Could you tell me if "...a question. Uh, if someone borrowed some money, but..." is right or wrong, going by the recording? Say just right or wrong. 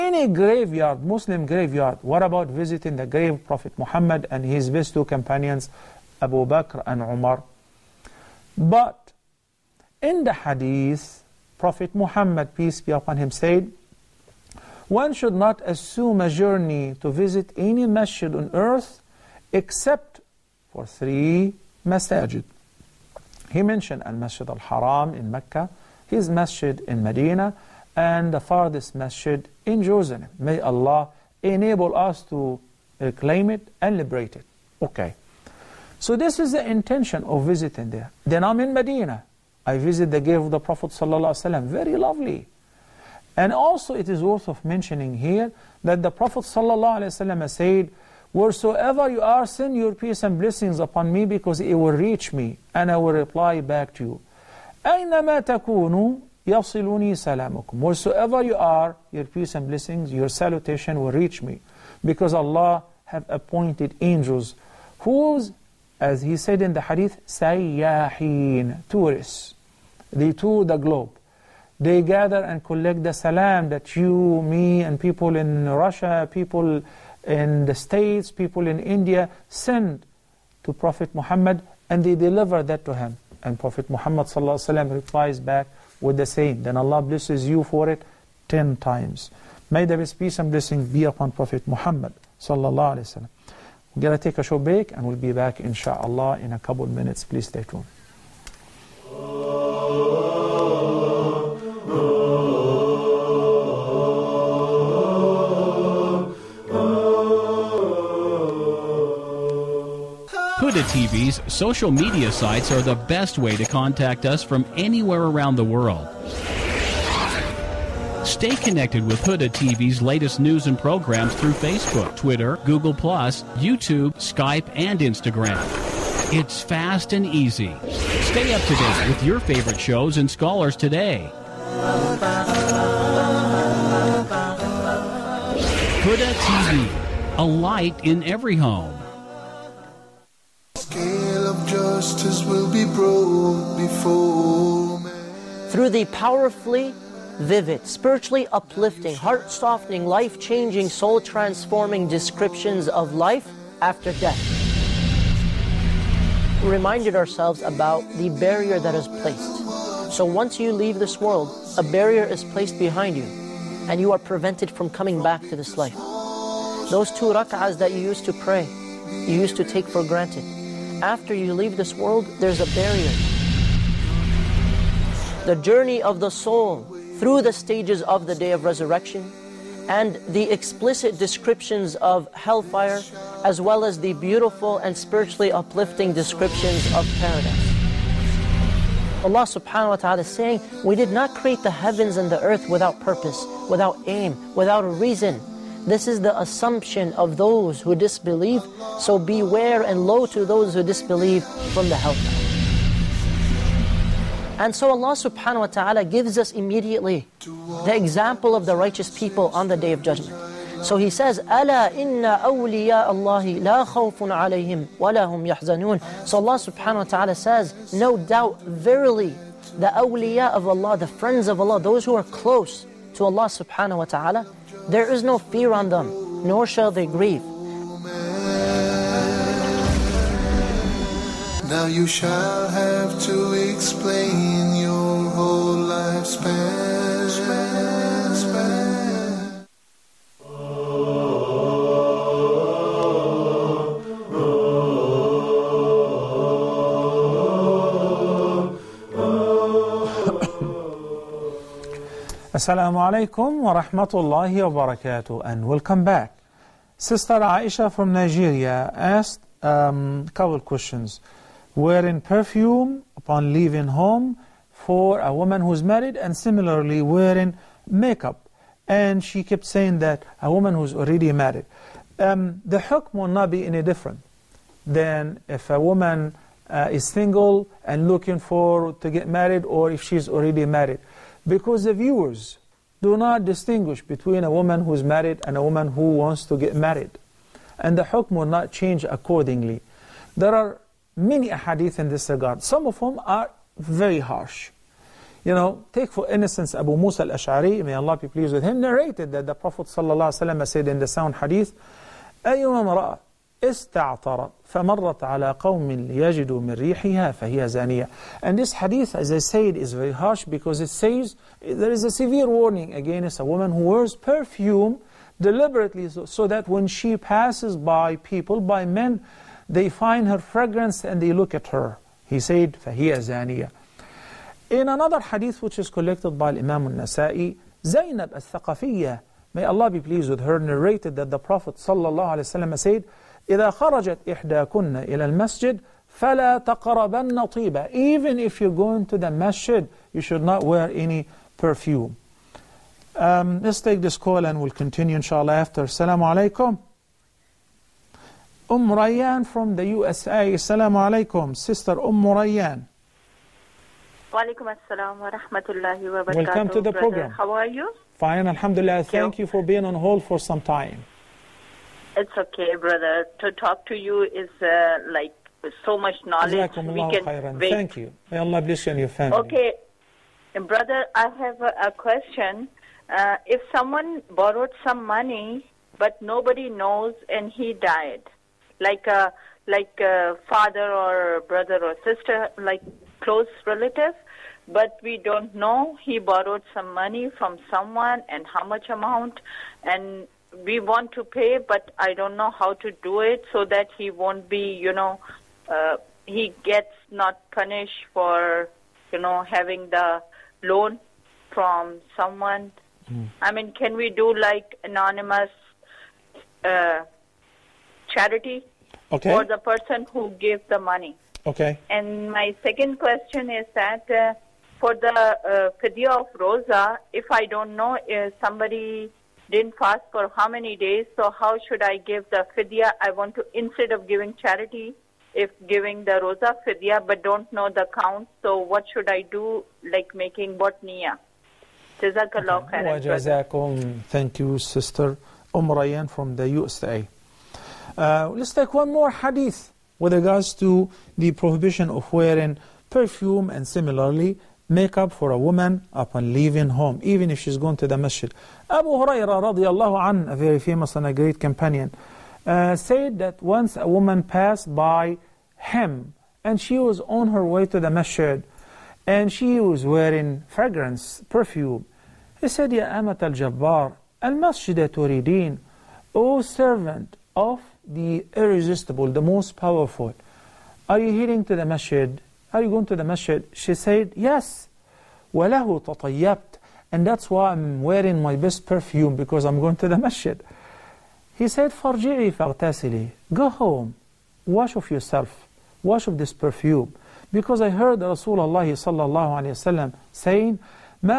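right.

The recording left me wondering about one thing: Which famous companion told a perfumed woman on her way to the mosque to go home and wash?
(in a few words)
Abu Hurairah.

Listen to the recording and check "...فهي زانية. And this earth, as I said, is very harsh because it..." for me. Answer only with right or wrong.
wrong.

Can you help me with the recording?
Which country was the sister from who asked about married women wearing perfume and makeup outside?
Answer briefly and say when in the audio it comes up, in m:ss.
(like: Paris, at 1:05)
Nigeria, at 4:18.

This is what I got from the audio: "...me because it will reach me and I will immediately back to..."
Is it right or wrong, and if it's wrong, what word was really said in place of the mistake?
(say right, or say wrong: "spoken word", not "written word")
wrong: "reply", not "immediately".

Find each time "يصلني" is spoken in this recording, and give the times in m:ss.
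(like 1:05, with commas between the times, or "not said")
0:56.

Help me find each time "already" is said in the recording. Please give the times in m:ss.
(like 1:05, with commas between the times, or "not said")
4:30, 4:40.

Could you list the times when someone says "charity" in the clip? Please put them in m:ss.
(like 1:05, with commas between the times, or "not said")
6:48, 7:04.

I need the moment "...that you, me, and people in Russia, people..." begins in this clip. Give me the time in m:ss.
1:13.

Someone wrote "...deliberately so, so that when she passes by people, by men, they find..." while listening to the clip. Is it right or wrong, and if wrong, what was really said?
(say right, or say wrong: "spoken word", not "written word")
right.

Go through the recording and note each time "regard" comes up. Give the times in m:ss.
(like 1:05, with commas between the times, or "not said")
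4:52, 7:20.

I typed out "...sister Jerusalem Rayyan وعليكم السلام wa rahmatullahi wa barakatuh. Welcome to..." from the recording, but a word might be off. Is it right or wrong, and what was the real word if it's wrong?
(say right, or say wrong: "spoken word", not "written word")
wrong: "Umm", not "Jerusalem".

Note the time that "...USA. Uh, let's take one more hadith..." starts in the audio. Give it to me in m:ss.
7:16.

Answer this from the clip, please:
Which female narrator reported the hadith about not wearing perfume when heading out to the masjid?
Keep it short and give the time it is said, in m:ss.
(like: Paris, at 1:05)
Zainab al-Thaqafiyya, at 5:27.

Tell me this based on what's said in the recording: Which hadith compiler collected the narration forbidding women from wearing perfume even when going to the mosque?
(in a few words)
Imam al-Nasa'i.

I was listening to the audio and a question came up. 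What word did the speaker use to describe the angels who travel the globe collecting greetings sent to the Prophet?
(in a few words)
Tourists.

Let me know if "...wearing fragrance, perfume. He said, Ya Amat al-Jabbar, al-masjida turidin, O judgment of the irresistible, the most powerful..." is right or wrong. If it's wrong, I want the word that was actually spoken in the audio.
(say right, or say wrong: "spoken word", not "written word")
wrong: "servant", not "judgment".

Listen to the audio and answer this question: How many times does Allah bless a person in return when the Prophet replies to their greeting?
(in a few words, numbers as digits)
10 times.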